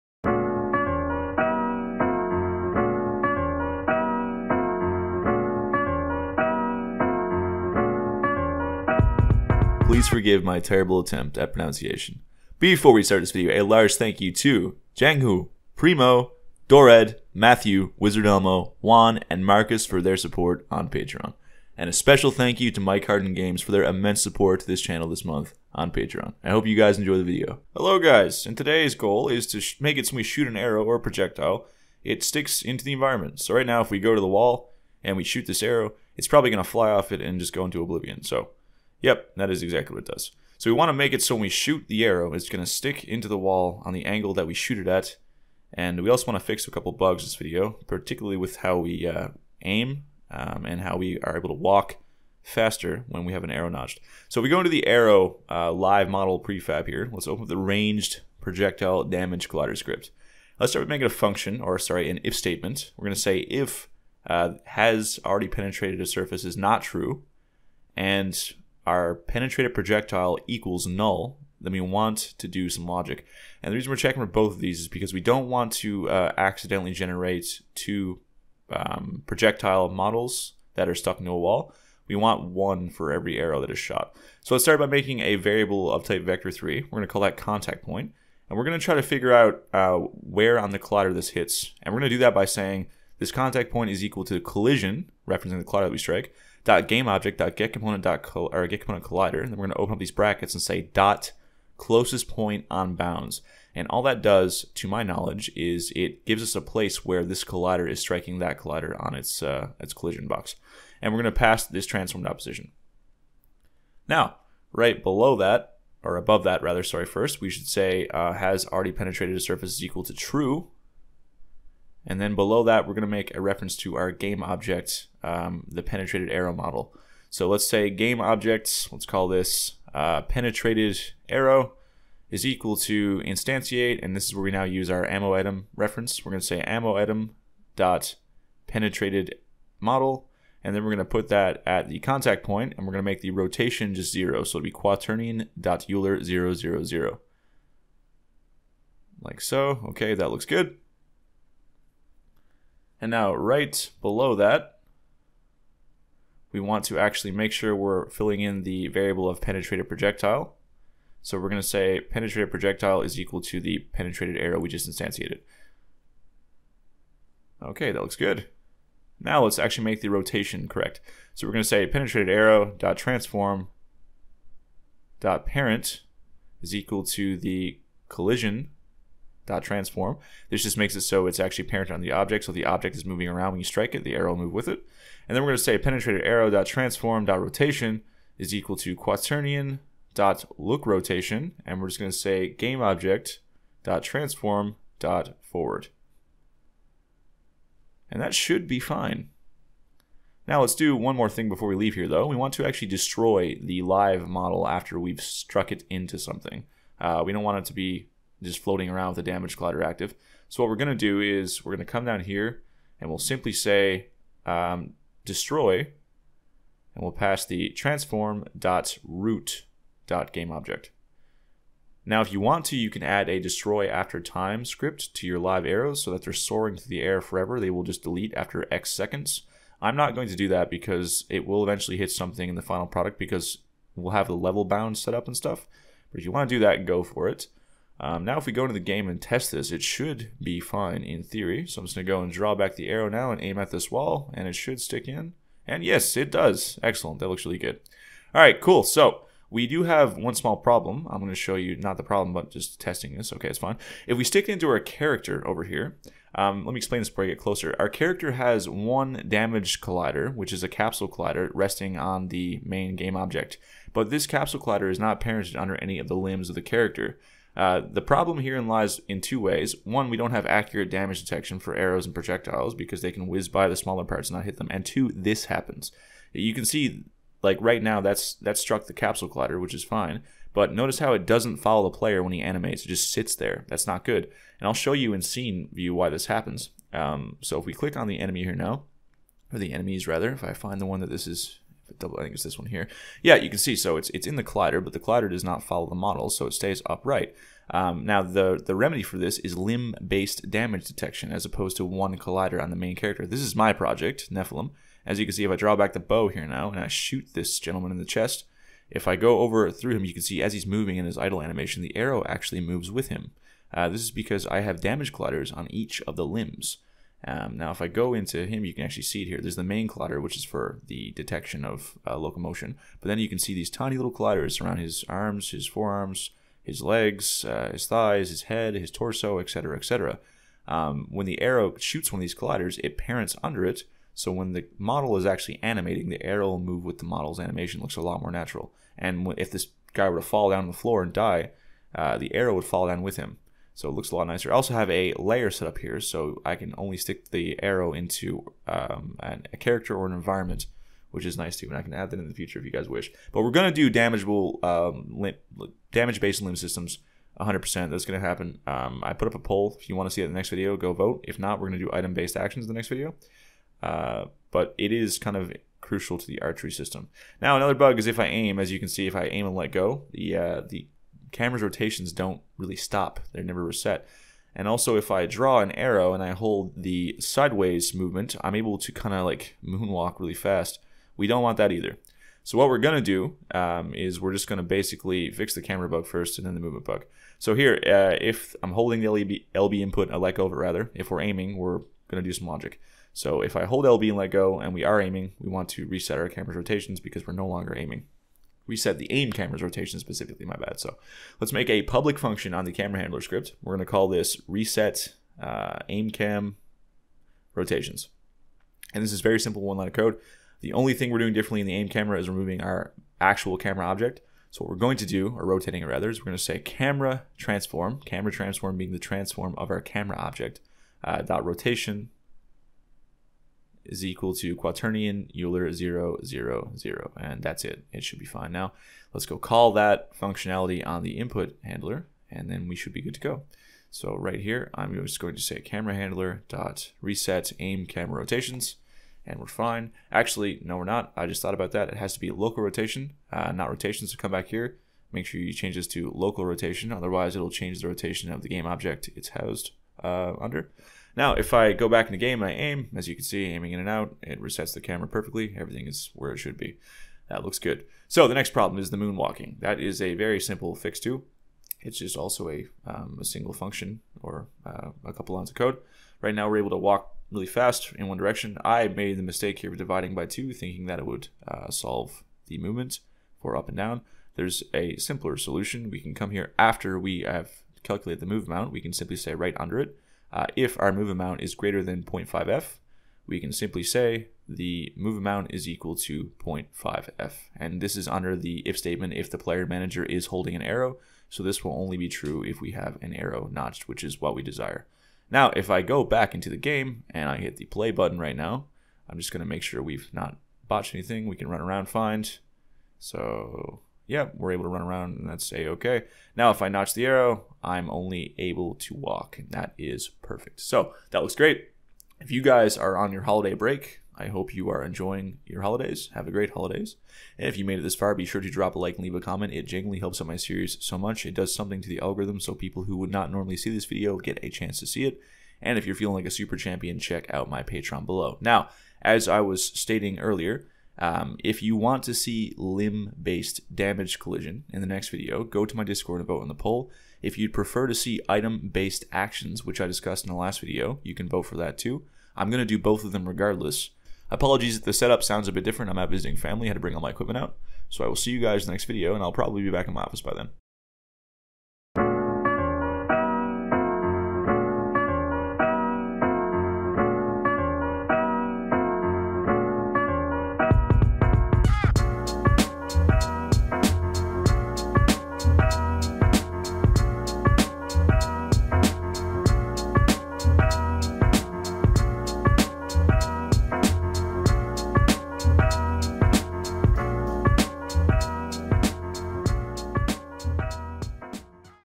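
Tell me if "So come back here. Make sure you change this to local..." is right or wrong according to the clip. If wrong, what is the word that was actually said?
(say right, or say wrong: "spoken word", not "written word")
right.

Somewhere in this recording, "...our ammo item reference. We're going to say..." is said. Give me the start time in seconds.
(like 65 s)
134 s.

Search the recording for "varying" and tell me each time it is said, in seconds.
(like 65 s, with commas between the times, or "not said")
not said.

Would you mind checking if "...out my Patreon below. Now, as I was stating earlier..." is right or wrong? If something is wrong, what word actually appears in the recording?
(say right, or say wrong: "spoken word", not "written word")
right.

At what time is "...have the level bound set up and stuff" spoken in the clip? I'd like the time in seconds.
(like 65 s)
234 s.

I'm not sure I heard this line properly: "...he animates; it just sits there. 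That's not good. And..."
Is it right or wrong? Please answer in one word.
right.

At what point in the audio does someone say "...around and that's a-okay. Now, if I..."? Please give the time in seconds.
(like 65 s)
504 s.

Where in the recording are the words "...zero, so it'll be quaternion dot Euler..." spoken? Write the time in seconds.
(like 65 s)
144 s.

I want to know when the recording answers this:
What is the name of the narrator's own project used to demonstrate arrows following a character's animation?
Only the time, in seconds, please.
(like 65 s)
304 s.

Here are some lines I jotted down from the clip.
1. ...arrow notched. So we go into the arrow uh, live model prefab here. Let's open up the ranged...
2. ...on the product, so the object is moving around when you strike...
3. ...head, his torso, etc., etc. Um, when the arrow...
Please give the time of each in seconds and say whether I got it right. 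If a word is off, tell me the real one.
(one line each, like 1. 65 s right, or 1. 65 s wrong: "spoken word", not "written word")
1. 53 s right
2. 181 s wrong: "object", not "product"
3. 328 s right.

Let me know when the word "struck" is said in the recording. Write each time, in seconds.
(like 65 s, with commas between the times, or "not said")
205 s, 278 s.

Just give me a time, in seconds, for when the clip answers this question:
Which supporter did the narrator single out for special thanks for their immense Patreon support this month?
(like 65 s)
22 s.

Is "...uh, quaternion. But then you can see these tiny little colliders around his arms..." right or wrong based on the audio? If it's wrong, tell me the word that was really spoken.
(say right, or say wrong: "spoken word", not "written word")
wrong: "locomotion", not "quaternion".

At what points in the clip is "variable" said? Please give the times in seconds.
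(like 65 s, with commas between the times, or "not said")
85 s, 158 s.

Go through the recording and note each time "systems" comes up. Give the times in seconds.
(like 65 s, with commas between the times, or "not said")
356 s, 366 s.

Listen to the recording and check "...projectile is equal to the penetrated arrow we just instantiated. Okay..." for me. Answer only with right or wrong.
right.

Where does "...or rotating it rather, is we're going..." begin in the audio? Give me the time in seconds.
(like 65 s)
415 s.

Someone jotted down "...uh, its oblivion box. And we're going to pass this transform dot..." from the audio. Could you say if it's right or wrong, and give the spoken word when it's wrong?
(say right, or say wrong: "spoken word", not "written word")
wrong: "collision", not "oblivion".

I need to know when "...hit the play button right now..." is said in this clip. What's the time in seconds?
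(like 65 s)
497 s.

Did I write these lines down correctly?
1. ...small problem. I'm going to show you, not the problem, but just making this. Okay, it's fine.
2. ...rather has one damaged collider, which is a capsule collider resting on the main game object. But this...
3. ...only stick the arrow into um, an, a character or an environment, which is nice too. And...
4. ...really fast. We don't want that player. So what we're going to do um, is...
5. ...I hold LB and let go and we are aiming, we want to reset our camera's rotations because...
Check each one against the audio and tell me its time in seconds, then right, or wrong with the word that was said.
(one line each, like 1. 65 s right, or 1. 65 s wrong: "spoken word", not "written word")
1. 250 s wrong: "testing", not "making"
2. 257 s wrong: "character", not "rather"
3. 346 s right
4. 380 s wrong: "either", not "player"
5. 393 s right.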